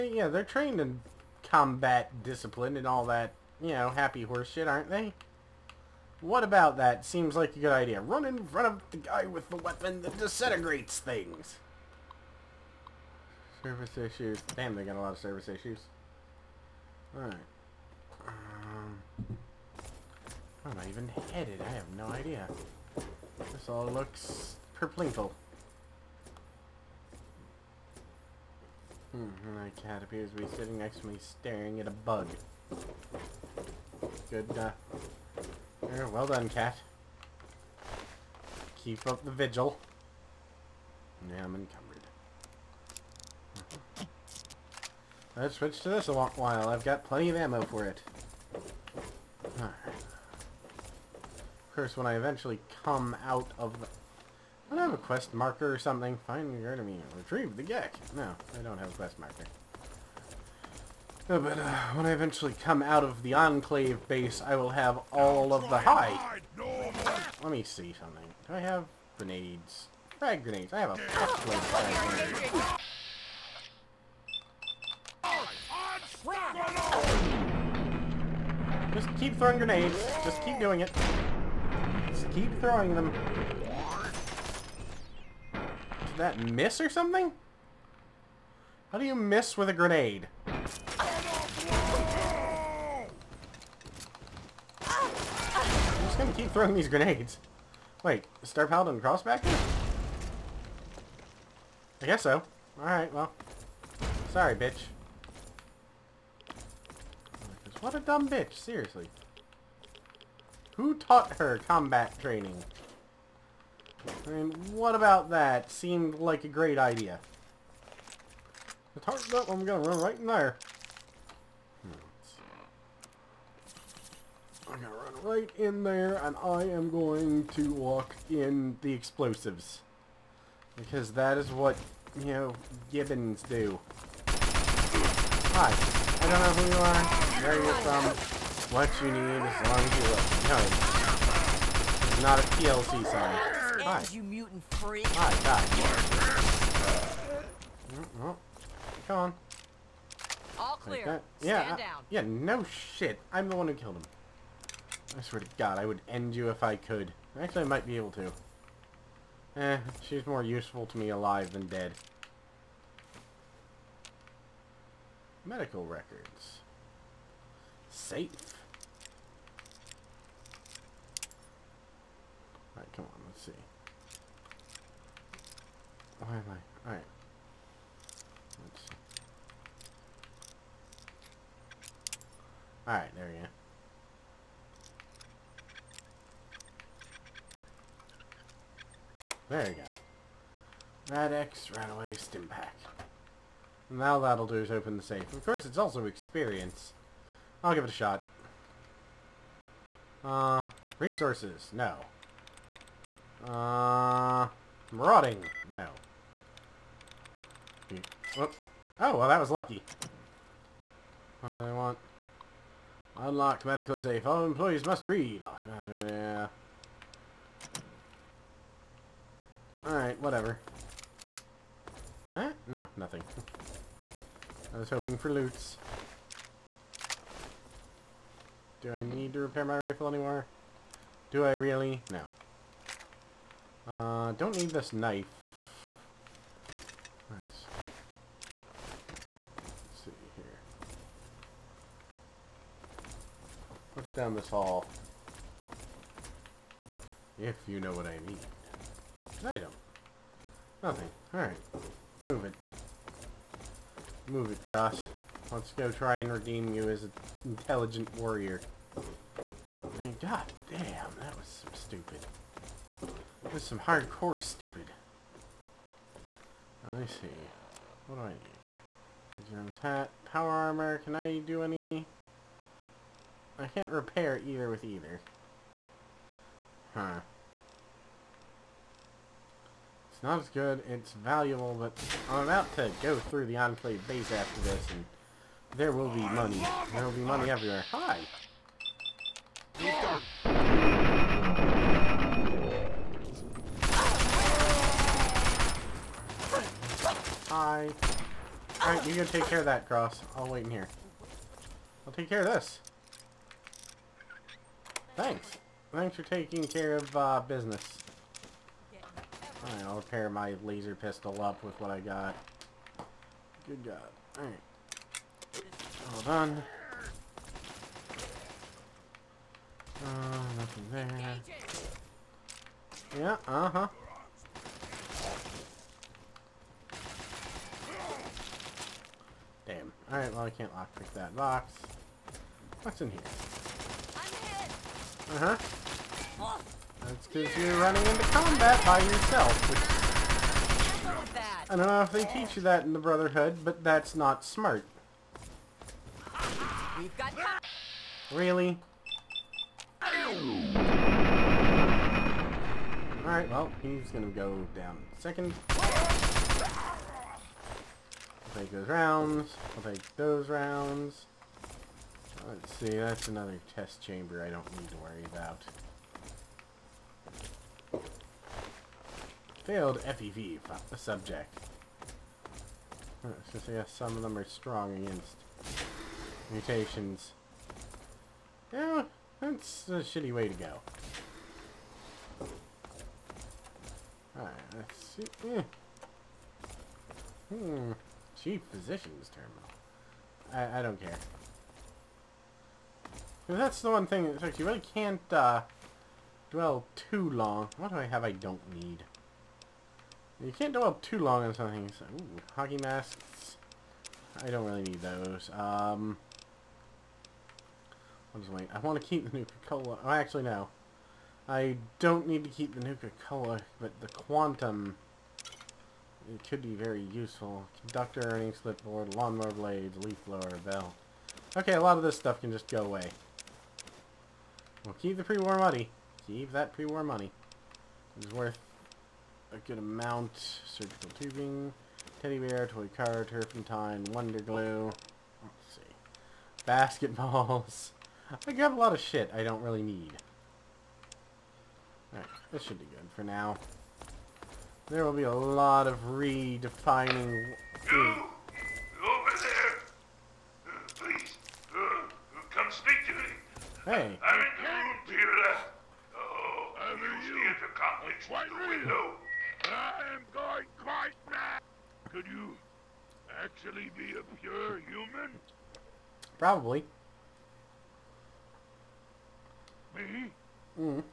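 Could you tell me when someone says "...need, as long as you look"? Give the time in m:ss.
2:19.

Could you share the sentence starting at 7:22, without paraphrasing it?
Alright, this should be good for now.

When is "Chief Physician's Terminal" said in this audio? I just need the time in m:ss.
6:28.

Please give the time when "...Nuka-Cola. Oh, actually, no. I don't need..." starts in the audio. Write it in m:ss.
6:49.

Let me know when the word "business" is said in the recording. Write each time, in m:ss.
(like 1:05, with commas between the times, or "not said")
5:07.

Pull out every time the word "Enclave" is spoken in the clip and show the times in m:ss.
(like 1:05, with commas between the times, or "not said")
1:03, 4:43.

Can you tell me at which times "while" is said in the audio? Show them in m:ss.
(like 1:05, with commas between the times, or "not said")
0:46.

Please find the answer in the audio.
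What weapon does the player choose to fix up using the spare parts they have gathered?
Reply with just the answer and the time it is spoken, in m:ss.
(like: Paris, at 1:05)
Laser pistol, at 5:10.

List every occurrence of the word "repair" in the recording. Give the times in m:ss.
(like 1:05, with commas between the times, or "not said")
3:49, 4:33.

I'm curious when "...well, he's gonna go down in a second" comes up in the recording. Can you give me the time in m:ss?
5:53.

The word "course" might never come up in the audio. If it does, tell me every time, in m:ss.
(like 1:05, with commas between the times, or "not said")
0:51, 3:15.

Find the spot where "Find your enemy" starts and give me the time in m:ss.
0:56.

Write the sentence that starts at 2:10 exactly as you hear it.
Because that is what, you know, gibbons do.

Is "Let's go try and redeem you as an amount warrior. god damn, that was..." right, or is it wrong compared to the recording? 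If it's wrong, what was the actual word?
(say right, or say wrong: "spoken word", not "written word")
wrong: "intelligent", not "amount".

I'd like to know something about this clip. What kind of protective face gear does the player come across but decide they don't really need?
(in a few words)
Hockey masks.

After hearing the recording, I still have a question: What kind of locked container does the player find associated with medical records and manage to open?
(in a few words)
Medical safe.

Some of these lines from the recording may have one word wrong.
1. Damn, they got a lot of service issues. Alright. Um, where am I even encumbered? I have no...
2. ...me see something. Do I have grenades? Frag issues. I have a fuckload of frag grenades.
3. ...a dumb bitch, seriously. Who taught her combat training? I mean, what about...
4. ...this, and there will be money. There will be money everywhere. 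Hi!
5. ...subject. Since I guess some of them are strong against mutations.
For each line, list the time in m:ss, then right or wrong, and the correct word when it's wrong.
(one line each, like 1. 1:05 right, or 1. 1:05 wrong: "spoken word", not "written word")
1. 0:14 wrong: "headed", not "encumbered"
2. 1:07 wrong: "grenades", not "issues"
3. 1:47 right
4. 4:44 right
5. 6:10 right.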